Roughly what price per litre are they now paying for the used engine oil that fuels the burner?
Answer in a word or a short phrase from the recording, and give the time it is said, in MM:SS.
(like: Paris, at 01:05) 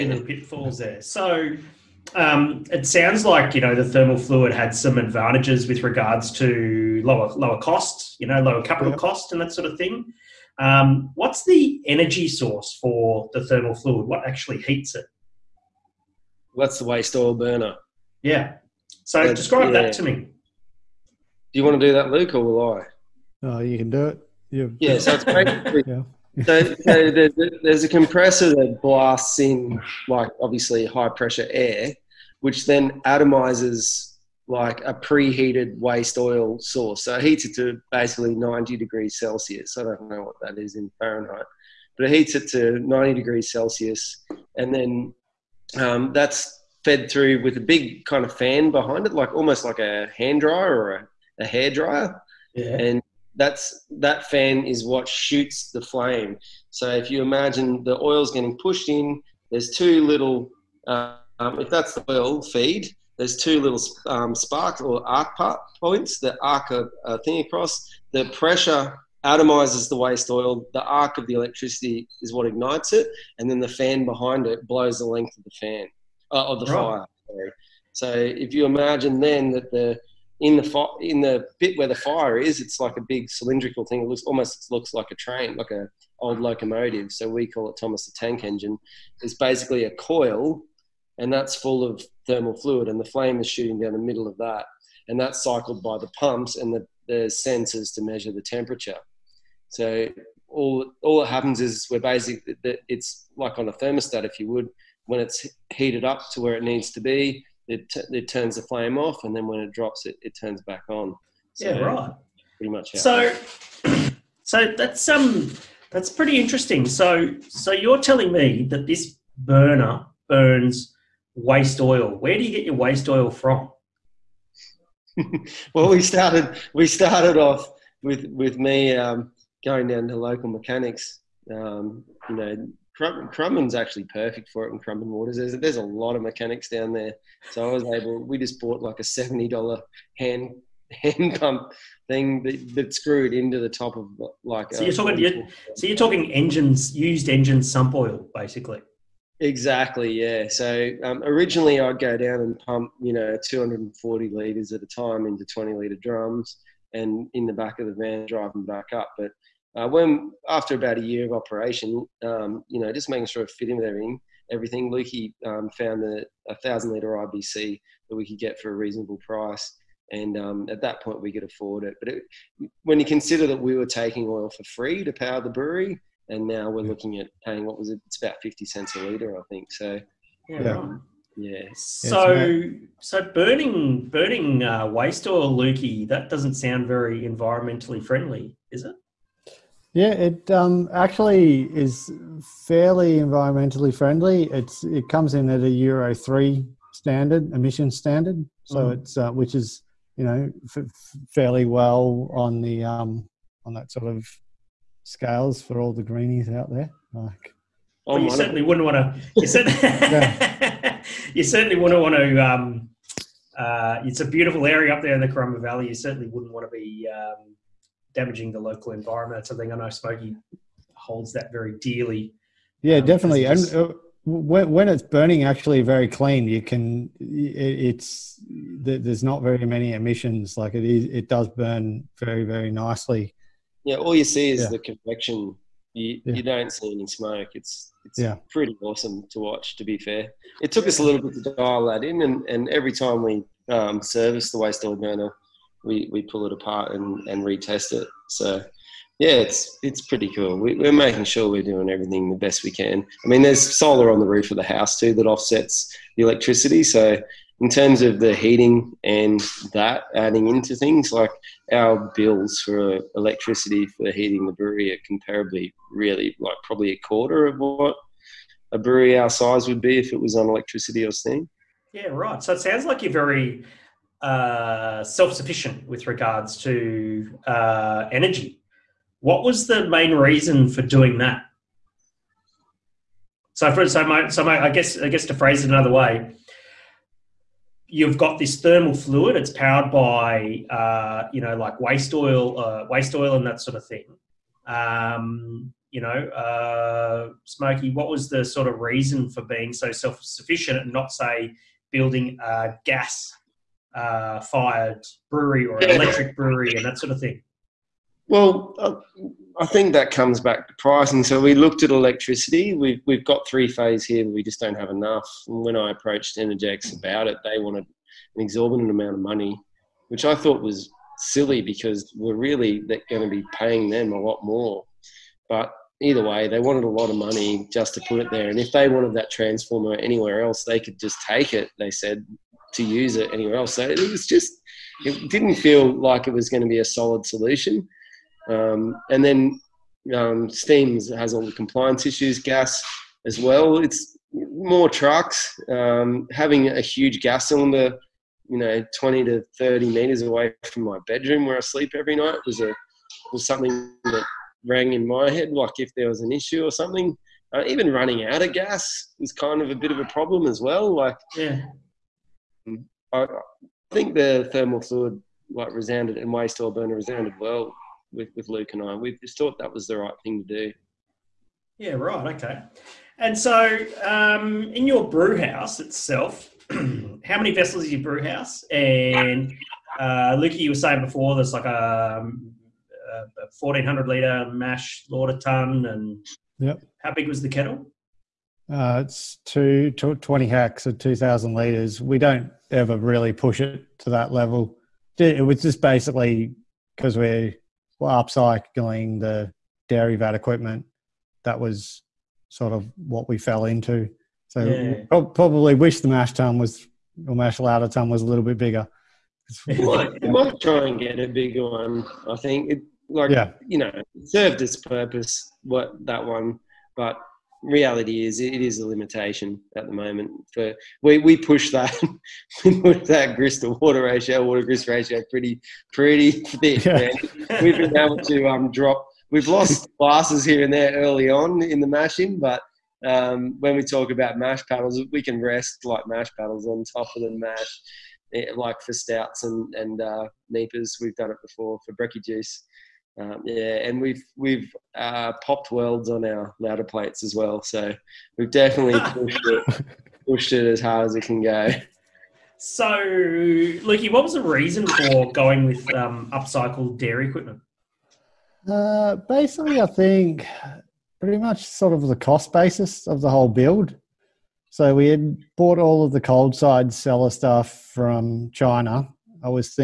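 50 cents, at 02:58.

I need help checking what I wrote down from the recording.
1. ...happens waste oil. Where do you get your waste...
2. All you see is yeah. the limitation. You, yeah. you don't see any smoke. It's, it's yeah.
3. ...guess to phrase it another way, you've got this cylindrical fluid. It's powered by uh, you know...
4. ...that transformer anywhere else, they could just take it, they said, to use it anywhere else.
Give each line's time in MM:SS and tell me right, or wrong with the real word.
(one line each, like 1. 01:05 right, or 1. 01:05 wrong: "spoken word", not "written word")
1. 02:00 wrong: "burns", not "happens"
2. 03:53 wrong: "convection", not "limitation"
3. 04:45 wrong: "thermal", not "cylindrical"
4. 05:29 right.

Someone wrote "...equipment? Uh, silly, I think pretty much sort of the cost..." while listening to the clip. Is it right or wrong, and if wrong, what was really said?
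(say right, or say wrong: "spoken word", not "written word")
wrong: "basically", not "silly".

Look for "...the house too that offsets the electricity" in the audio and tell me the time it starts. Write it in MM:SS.
04:14.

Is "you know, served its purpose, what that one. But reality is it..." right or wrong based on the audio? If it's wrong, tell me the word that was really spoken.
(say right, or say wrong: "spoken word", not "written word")
right.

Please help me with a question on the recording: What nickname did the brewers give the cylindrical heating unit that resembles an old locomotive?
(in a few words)
Thomas the Tank Engine.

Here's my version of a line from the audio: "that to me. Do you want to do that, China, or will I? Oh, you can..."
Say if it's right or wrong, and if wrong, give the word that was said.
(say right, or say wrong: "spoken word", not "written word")
wrong: "Luke", not "China".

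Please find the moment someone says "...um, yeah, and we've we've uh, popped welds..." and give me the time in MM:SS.
07:23.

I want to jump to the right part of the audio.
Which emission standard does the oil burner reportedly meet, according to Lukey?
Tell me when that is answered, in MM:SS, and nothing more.
03:15.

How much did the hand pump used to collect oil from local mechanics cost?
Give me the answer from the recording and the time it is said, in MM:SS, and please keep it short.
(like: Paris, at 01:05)
$70, at 02:19.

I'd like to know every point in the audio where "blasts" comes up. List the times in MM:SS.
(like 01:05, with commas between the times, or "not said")
00:28.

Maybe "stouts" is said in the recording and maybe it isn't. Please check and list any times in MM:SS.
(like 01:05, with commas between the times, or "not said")
07:18.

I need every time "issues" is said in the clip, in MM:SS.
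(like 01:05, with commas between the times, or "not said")
05:42, 05:56.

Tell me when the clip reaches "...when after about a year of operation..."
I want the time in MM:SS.
02:39.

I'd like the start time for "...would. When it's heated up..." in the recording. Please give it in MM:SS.
01:44.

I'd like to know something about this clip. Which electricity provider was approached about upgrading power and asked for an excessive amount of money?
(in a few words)
Energex.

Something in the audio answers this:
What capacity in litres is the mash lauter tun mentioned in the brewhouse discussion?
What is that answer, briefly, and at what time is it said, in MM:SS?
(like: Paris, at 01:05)
1400 litres, at 06:23.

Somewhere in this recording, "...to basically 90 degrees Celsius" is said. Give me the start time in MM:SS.
00:37.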